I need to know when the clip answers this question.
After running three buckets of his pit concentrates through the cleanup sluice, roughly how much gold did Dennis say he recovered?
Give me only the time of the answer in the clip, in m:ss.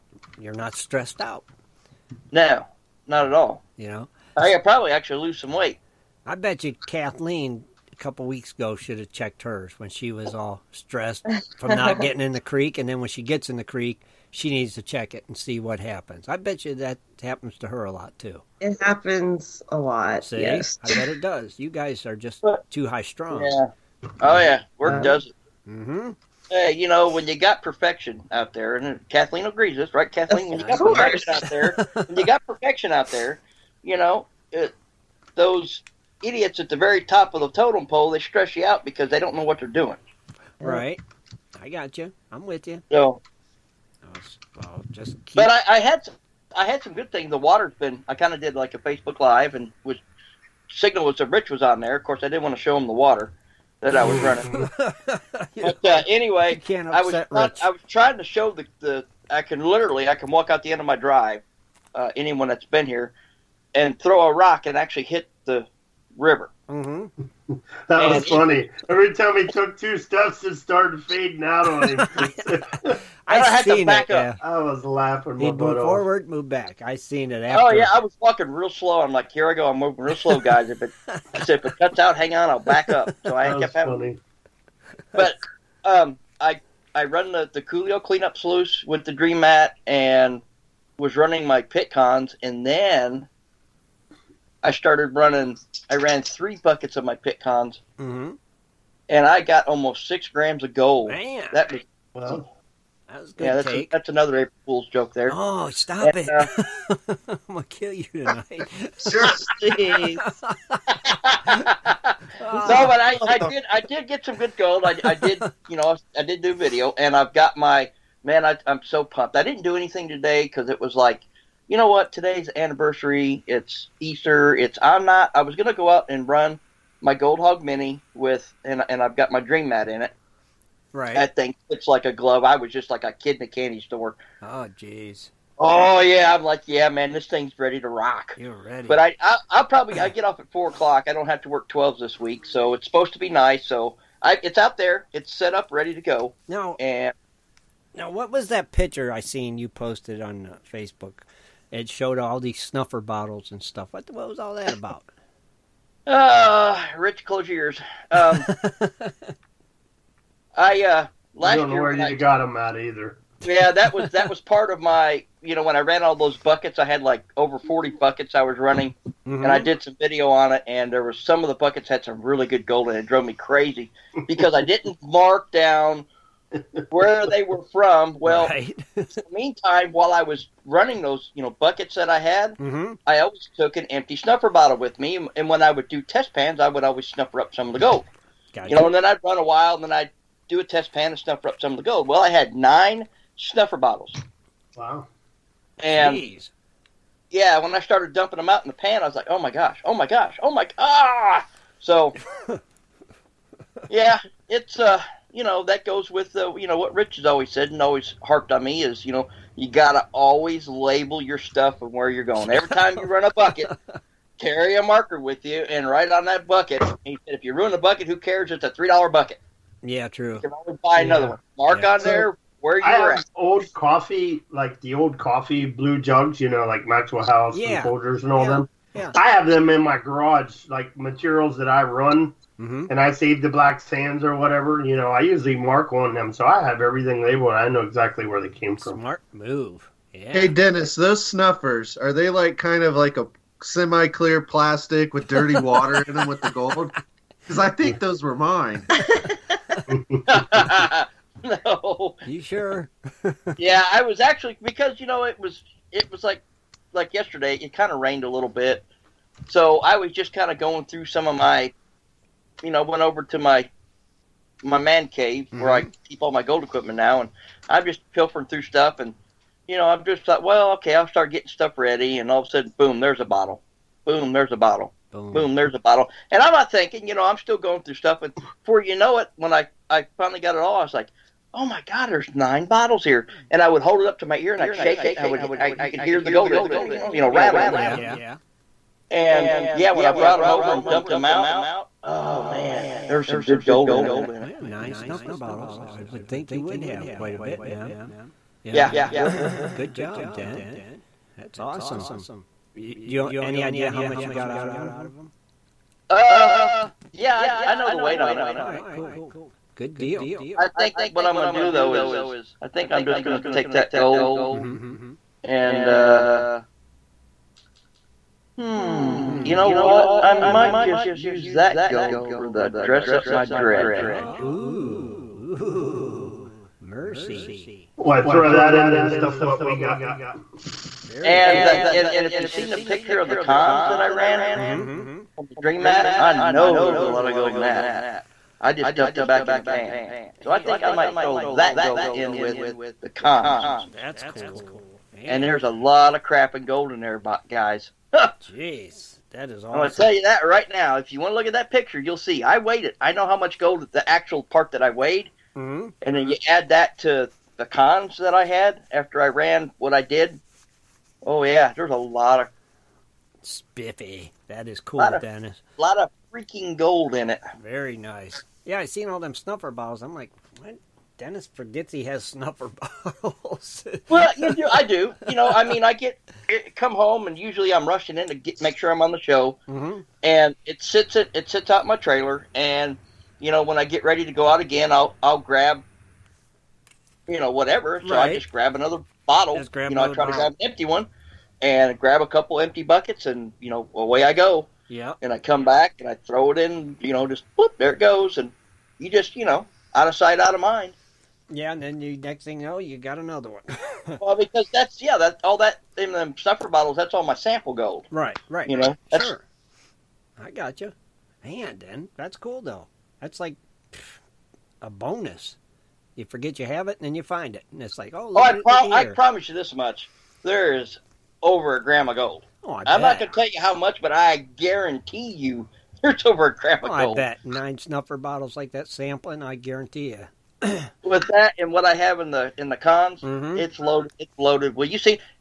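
1:39.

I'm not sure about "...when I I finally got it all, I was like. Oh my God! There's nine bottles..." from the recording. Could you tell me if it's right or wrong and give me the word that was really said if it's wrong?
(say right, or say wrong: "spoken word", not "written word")
right.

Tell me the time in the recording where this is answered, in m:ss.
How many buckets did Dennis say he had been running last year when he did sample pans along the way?
2:47.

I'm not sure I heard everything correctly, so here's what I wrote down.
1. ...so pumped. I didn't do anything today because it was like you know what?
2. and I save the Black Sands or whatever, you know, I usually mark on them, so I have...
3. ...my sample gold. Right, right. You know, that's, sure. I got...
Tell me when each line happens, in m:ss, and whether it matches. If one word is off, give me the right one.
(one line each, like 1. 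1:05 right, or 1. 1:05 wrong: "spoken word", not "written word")
1. 1:58 right
2. 3:52 right
3. 6:47 right.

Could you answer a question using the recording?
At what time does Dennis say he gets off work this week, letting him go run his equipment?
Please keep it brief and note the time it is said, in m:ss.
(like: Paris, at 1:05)
4 o'clock, at 2:20.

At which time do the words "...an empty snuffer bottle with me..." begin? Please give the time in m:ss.
3:03.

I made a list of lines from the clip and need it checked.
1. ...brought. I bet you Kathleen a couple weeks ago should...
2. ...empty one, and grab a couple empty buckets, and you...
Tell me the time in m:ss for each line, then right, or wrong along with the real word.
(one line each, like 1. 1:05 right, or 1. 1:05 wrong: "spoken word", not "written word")
1. 0:05 wrong: "weight", not "brought"
2. 6:30 right.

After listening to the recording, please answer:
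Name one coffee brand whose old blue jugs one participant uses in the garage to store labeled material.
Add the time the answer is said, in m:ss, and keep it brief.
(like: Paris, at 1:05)
Maxwell House, at 3:46.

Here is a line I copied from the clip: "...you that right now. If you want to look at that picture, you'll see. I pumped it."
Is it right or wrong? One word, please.
wrong.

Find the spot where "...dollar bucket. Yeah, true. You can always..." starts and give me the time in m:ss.
3:38.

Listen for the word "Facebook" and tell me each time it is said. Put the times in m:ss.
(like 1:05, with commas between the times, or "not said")
0:48, 2:30.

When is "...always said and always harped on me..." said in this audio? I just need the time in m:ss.
3:27.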